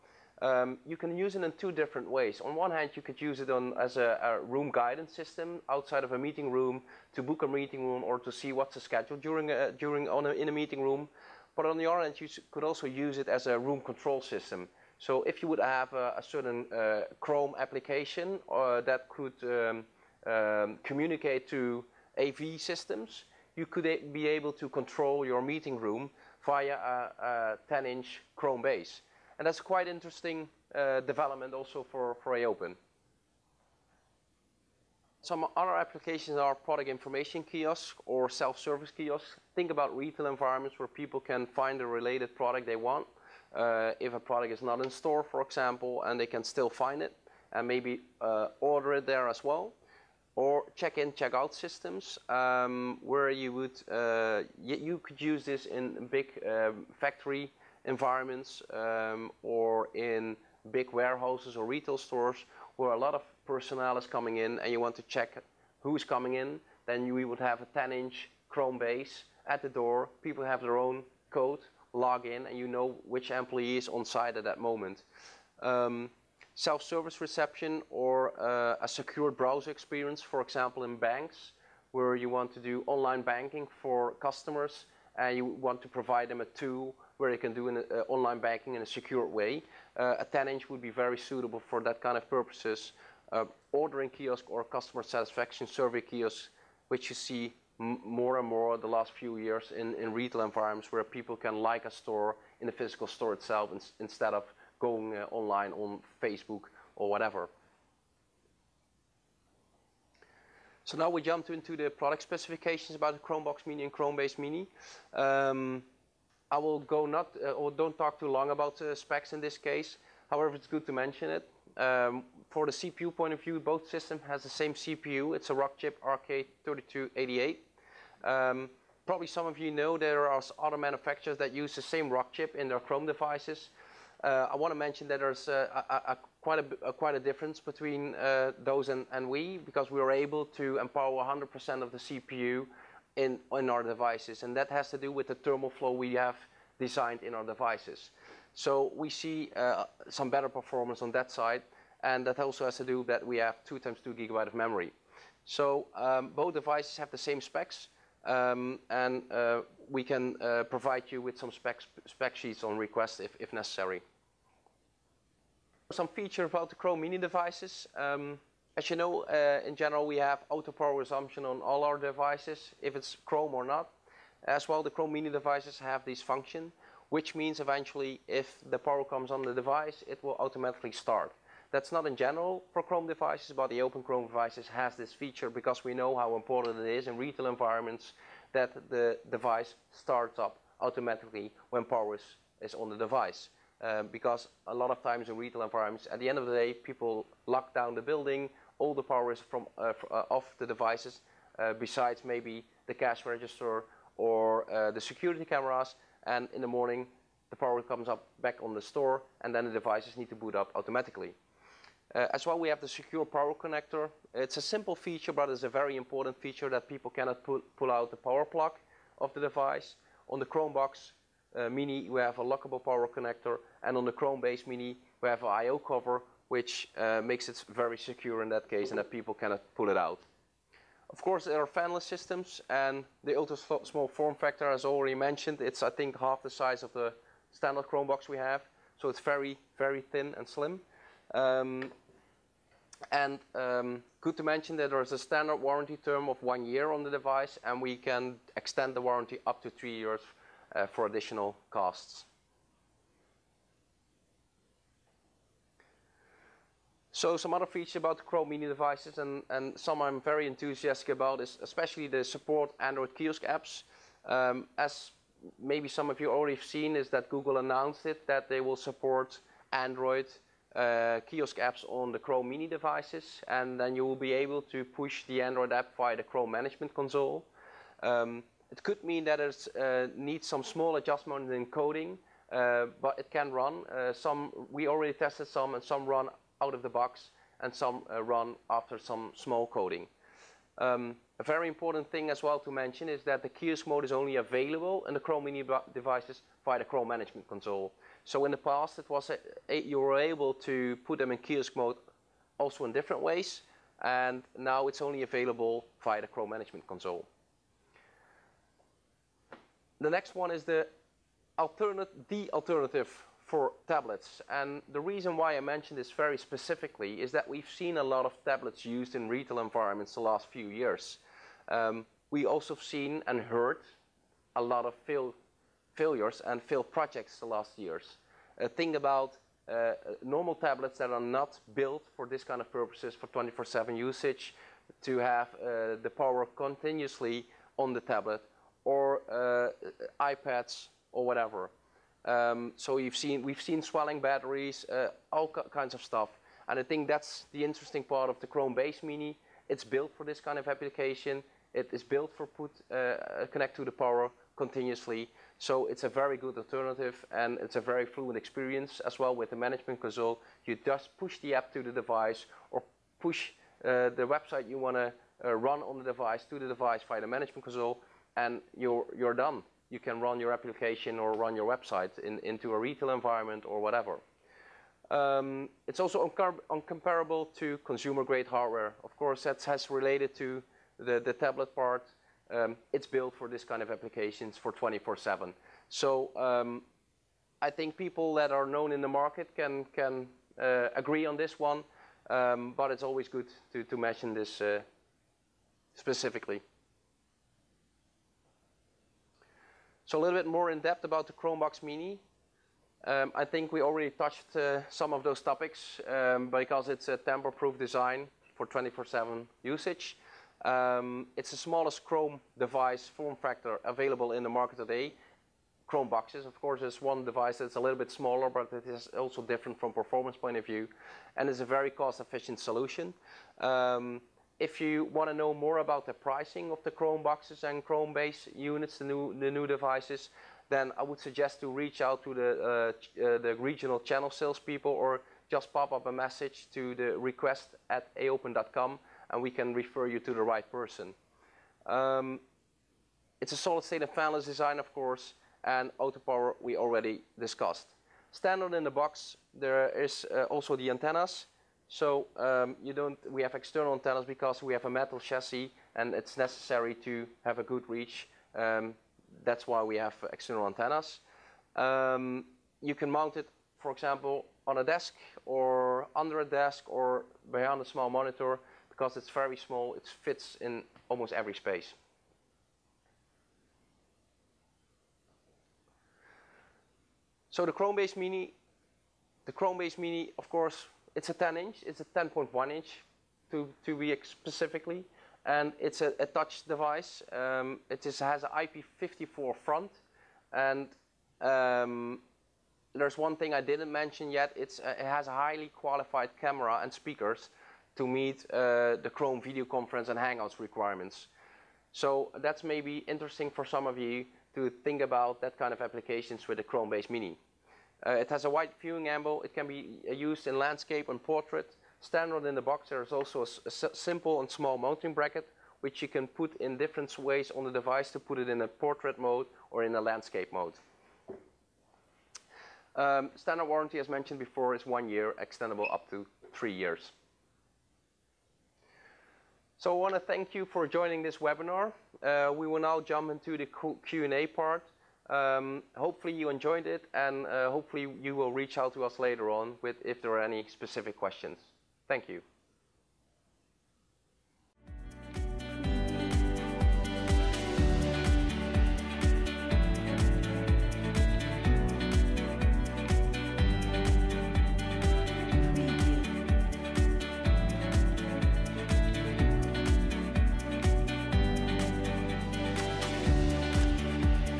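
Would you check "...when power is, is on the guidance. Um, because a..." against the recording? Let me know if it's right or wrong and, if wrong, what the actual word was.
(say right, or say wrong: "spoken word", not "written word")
wrong: "device", not "guidance".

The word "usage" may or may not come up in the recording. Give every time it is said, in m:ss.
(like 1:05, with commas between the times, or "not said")
5:33, 6:49.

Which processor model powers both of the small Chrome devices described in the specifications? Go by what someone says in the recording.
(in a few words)
Rockchip RK3288.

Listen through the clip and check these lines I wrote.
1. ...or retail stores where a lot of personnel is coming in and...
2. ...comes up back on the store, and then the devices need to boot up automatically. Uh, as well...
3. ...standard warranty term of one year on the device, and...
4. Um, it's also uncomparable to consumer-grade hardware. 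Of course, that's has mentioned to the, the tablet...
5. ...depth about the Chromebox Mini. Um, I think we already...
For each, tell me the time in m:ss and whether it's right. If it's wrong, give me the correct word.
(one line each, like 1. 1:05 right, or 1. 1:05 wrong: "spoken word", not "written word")
1. 1:01 right
2. 3:27 right
3. 4:05 right
4. 6:15 wrong: "related", not "mentioned"
5. 6:40 right.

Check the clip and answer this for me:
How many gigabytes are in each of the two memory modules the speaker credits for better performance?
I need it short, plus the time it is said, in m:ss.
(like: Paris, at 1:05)
2, at 2:33.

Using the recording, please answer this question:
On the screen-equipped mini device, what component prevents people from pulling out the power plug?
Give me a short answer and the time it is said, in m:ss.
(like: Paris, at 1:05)
I/O cover, at 3:45.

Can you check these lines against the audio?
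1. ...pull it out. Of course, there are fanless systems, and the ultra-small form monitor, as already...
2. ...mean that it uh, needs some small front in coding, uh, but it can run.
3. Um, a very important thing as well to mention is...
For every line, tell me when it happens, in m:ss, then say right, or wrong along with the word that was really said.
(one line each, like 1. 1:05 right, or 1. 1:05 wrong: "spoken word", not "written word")
1. 3:49 wrong: "factor", not "monitor"
2. 4:39 wrong: "adjustment", not "front"
3. 4:50 right.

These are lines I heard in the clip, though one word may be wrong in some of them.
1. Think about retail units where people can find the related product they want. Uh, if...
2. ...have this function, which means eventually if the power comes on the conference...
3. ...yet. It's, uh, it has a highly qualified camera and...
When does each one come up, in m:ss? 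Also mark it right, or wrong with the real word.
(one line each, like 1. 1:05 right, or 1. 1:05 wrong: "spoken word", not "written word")
1. 0:39 wrong: "environments", not "units"
2. 2:55 wrong: "device", not "conference"
3. 8:14 right.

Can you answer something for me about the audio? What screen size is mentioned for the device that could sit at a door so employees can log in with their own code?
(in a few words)
10-inch.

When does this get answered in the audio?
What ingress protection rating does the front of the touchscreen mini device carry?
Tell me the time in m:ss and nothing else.
8:08.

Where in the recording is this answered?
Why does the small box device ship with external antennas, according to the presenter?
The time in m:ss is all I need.
7:34.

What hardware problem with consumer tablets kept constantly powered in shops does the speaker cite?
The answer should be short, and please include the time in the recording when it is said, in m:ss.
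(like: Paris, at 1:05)
Swelling batteries, at 5:43.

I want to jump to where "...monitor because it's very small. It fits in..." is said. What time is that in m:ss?
7:48.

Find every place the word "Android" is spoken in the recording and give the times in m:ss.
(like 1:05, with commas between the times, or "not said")
4:22, 4:29, 4:35.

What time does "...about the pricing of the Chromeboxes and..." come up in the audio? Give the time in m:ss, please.
7:05.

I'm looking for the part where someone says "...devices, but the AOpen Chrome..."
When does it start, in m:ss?
3:03.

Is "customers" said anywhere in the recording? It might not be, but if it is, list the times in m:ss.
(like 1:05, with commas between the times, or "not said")
1:24, 1:34.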